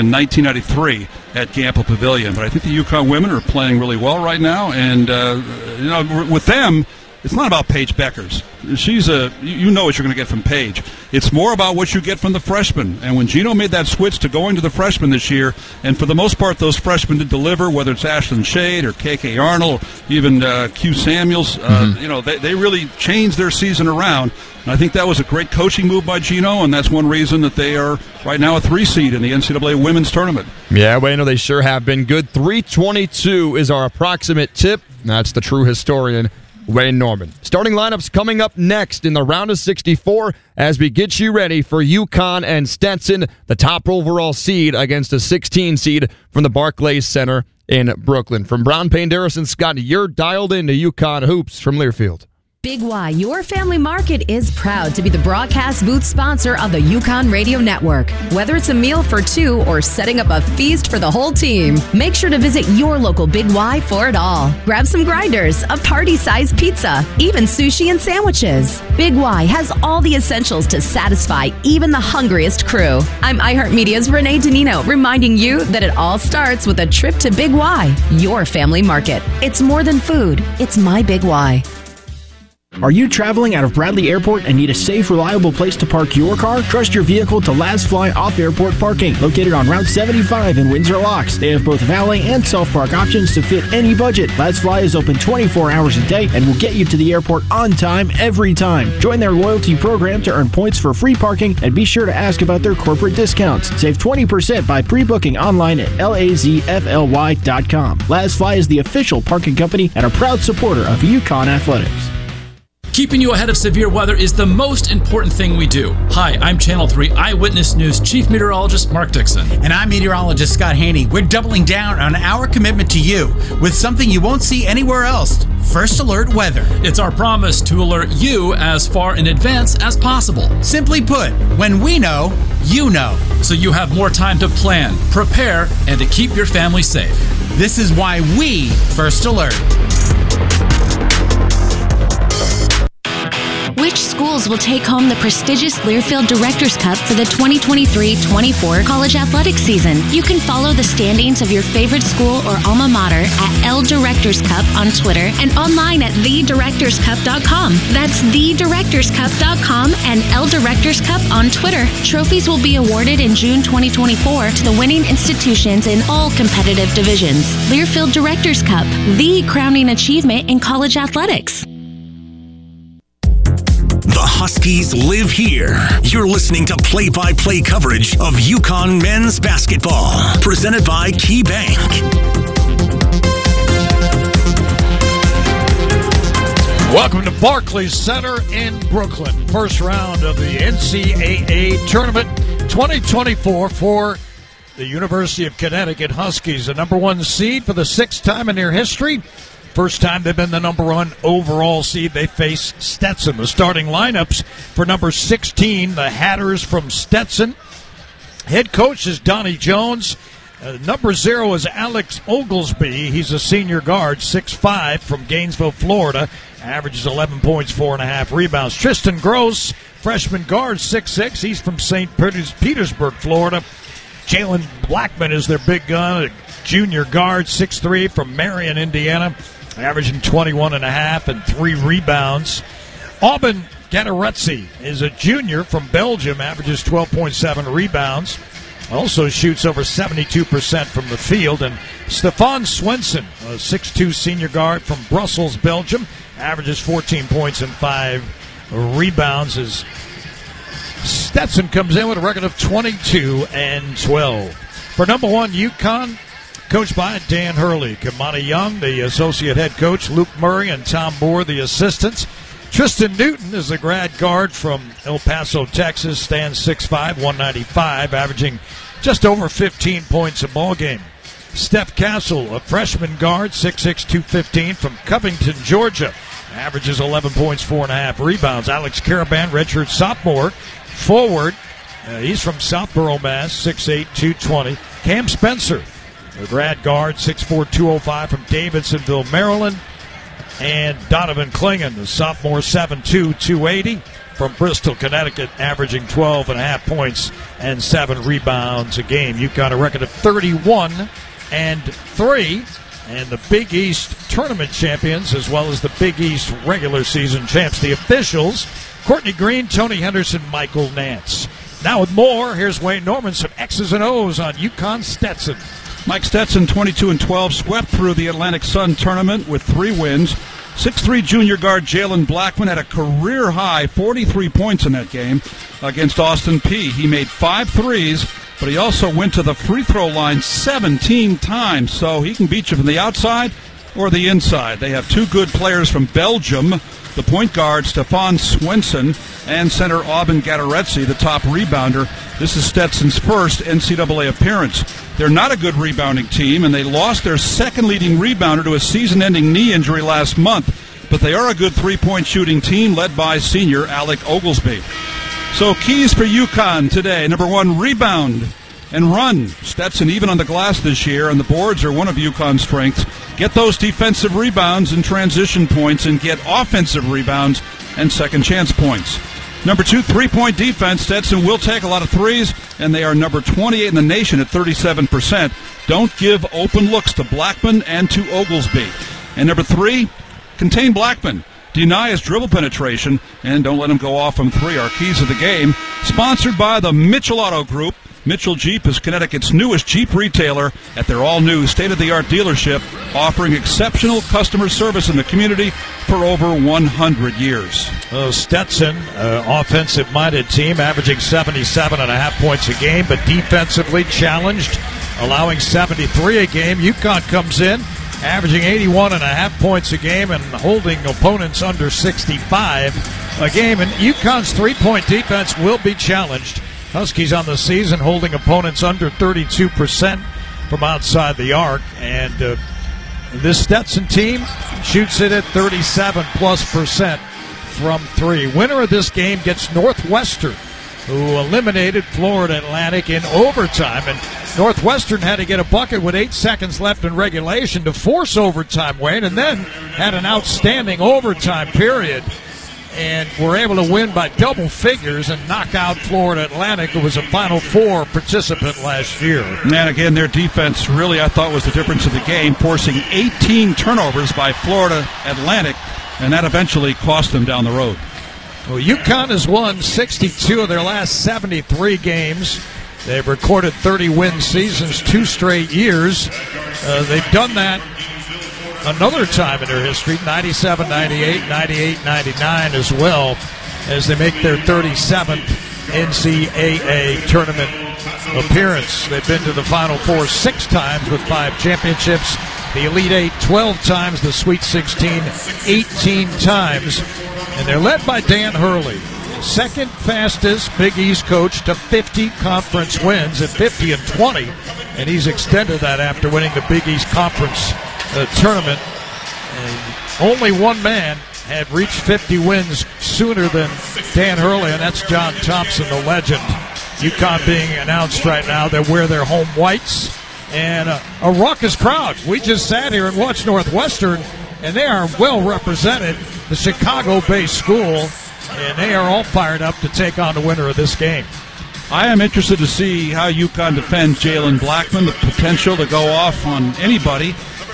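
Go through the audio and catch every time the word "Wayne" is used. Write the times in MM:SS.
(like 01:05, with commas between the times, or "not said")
00:36, 05:12, 07:18.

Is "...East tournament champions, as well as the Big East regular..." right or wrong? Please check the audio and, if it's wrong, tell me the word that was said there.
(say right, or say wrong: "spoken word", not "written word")
right.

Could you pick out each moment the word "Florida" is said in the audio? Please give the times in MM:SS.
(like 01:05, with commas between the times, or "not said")
03:35, 03:43, 07:12, 07:25, 07:34.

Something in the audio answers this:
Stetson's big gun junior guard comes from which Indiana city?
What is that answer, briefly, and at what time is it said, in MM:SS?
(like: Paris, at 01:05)
Marion, at 03:48.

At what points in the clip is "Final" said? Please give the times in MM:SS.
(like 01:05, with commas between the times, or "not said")
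07:27, 07:59.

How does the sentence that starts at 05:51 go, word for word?
But they are a good three point shooting team led by senior Alec Oglesby.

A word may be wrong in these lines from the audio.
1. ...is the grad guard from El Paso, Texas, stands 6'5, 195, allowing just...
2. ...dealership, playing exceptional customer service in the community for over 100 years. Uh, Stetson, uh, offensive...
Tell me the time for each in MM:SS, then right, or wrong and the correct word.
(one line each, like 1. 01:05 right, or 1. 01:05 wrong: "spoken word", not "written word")
1. 04:23 wrong: "averaging", not "allowing"
2. 06:32 wrong: "offering", not "playing".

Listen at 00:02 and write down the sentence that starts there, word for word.
But I think the UConn women are playing really well right now.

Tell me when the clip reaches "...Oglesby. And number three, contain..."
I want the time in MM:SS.
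06:18.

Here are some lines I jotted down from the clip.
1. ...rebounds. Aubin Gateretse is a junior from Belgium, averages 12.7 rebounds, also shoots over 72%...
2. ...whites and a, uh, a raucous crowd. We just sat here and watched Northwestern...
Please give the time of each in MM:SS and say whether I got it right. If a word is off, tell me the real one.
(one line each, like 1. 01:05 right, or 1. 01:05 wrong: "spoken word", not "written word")
1. 03:51 right
2. 08:29 right.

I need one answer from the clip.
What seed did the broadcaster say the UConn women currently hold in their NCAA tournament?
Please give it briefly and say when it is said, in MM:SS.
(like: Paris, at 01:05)
3, at 00:28.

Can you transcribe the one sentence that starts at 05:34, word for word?
They have two good players from Belgium the point guard Stefan Swenson, and center Aubin Gateretse, the top rebounder.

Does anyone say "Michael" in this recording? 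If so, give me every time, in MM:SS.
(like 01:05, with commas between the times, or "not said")
05:10.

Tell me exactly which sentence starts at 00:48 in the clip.
From Brown Paindiris Scott, you're dialed into UConn Hoops from Learfield.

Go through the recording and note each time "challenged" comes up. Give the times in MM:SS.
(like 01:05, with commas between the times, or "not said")
06:44, 06:55.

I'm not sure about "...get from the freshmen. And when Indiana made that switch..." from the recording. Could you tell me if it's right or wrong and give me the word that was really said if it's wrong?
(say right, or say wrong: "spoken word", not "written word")
wrong: "Gino", not "Indiana".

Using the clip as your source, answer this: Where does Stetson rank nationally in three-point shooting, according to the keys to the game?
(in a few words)
28.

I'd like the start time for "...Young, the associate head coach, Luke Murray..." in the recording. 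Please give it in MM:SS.
04:18.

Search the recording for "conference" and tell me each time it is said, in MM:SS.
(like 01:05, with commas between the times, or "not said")
08:12, 08:17.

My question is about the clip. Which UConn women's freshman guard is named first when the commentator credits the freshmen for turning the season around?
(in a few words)
Ashlynn Shade.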